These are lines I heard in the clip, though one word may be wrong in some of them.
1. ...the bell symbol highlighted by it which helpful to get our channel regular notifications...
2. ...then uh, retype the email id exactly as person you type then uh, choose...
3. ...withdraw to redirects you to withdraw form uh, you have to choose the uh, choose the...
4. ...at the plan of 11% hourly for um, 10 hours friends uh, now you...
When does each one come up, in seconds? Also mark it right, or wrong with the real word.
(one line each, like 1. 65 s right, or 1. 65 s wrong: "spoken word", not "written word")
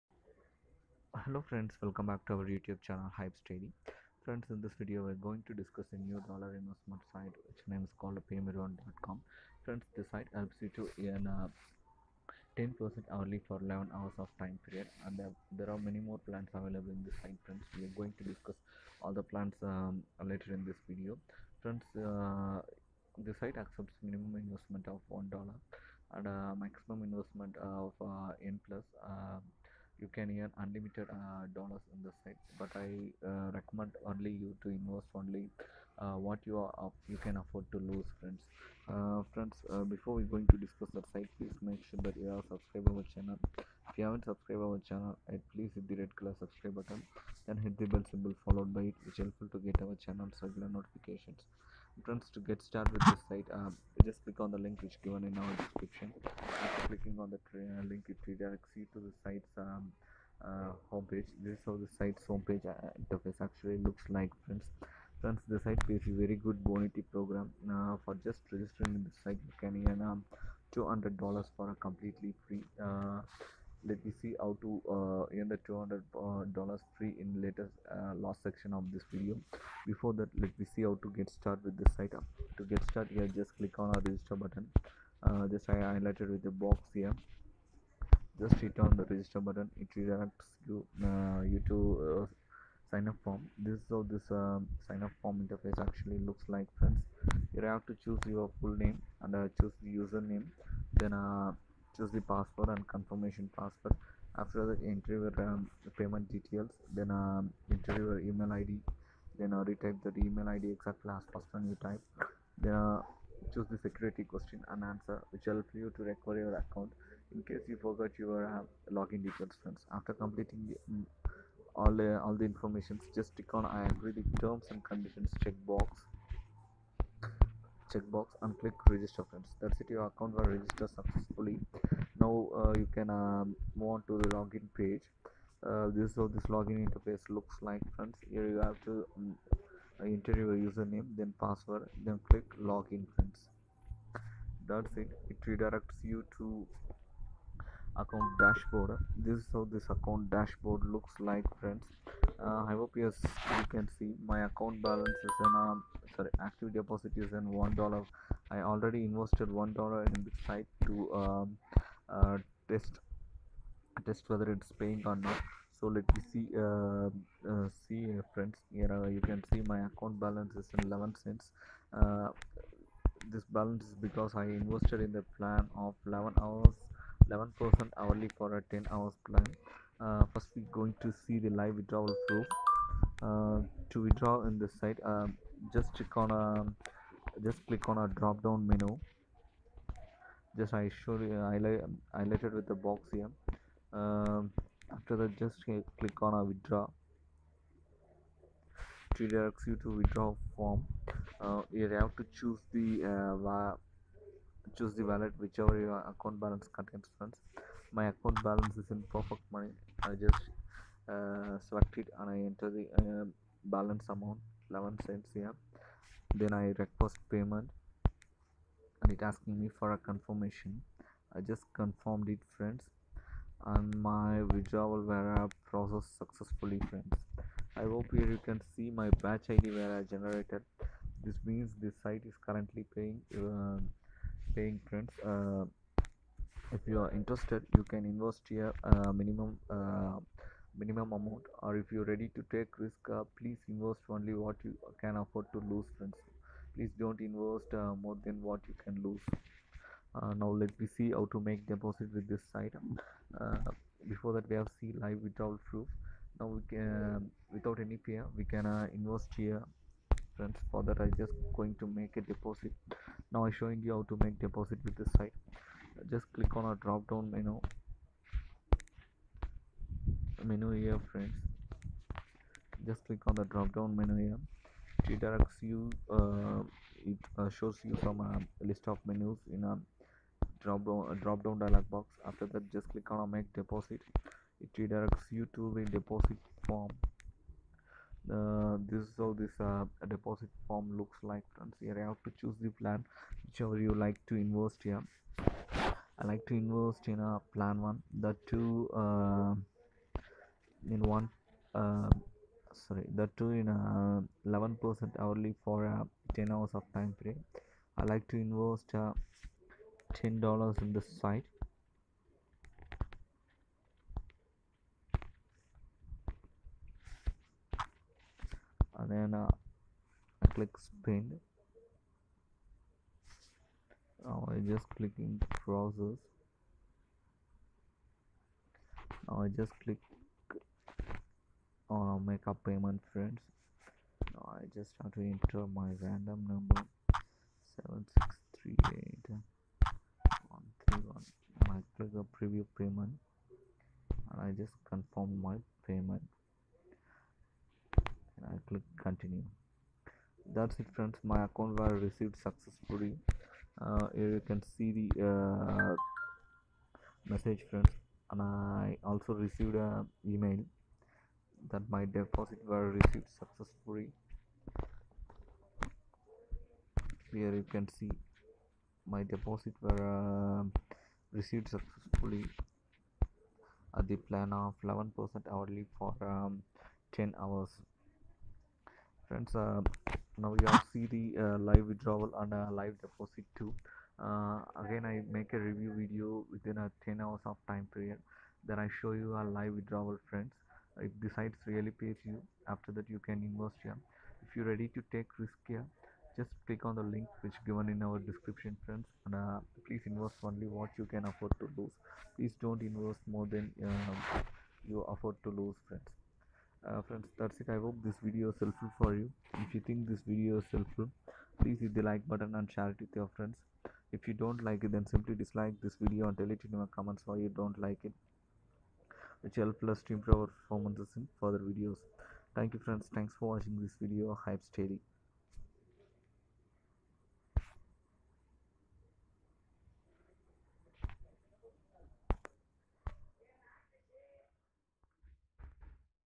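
1. 47 s wrong: "followed", not "highlighted"
2. 109 s right
3. 196 s wrong: "directs", not "redirects"
4. 373 s right.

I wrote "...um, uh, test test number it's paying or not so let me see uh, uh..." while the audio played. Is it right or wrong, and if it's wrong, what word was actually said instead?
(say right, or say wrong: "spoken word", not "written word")
wrong: "whether", not "number".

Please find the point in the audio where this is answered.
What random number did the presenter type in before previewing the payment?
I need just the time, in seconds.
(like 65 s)
338 s.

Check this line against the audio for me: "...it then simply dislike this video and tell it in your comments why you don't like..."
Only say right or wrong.
right.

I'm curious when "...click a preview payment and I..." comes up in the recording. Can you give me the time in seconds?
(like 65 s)
341 s.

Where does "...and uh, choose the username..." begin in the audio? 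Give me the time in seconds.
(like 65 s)
99 s.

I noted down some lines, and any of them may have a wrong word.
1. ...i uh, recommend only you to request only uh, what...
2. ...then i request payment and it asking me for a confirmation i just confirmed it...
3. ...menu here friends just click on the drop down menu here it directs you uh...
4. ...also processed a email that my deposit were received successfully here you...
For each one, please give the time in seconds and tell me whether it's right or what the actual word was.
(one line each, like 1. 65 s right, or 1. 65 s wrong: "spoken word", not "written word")
1. 32 s wrong: "invest", not "request"
2. 216 s right
3. 270 s right
4. 359 s wrong: "received", not "processed".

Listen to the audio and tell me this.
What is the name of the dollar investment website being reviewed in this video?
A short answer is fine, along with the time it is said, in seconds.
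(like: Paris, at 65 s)
paymeron.com, at 8 s.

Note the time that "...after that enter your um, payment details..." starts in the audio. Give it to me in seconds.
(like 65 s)
104 s.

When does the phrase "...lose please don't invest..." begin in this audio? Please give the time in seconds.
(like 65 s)
401 s.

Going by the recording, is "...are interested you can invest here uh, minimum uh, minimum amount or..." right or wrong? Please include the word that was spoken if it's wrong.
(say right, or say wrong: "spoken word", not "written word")
right.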